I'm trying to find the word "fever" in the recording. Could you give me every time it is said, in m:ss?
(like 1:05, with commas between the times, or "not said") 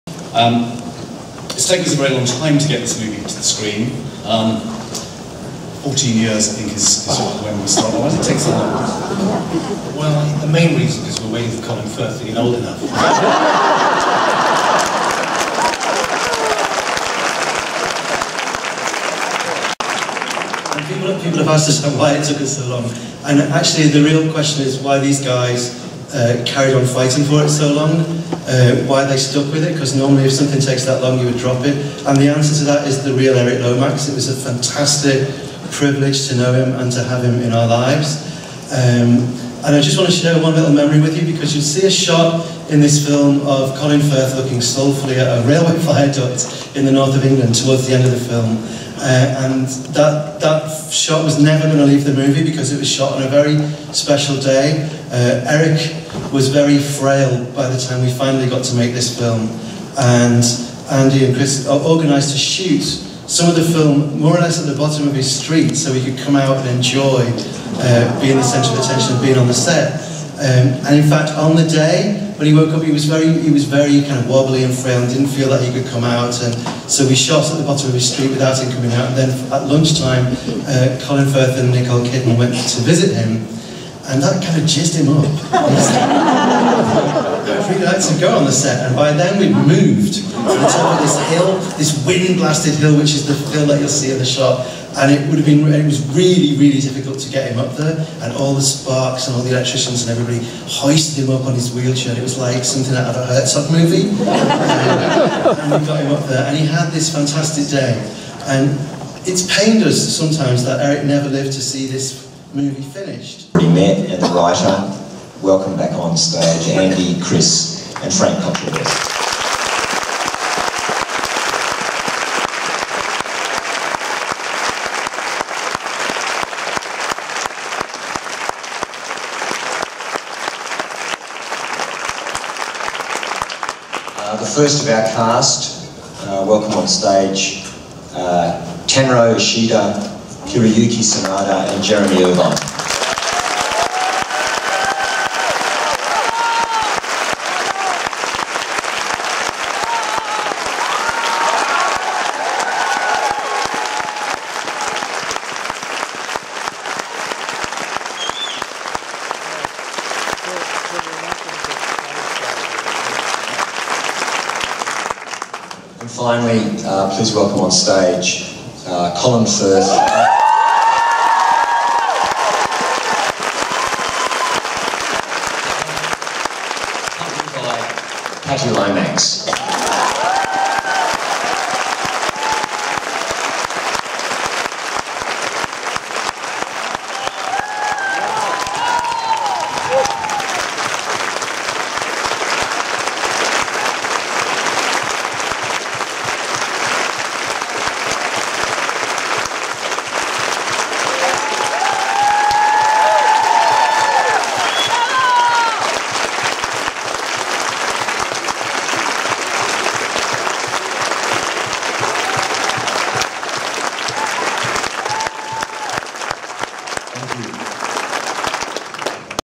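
not said.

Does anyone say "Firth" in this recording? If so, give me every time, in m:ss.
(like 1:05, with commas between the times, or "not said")
0:11, 0:44, 1:21, 2:49.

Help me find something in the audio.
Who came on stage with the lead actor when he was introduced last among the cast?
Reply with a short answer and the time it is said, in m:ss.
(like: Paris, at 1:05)
Patti Lomax, at 2:58.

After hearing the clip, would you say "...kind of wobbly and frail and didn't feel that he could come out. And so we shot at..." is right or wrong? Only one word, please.
right.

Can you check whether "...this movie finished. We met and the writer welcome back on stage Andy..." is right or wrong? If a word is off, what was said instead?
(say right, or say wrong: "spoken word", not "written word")
right.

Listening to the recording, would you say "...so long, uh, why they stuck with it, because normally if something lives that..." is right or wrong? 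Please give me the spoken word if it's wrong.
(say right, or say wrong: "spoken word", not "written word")
wrong: "takes", not "lives".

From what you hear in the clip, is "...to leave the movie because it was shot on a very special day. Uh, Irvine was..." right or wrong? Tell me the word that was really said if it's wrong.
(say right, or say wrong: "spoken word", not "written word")
wrong: "Eric", not "Irvine".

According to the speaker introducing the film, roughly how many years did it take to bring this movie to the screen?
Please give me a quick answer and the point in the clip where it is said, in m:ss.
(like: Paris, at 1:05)
14, at 0:05.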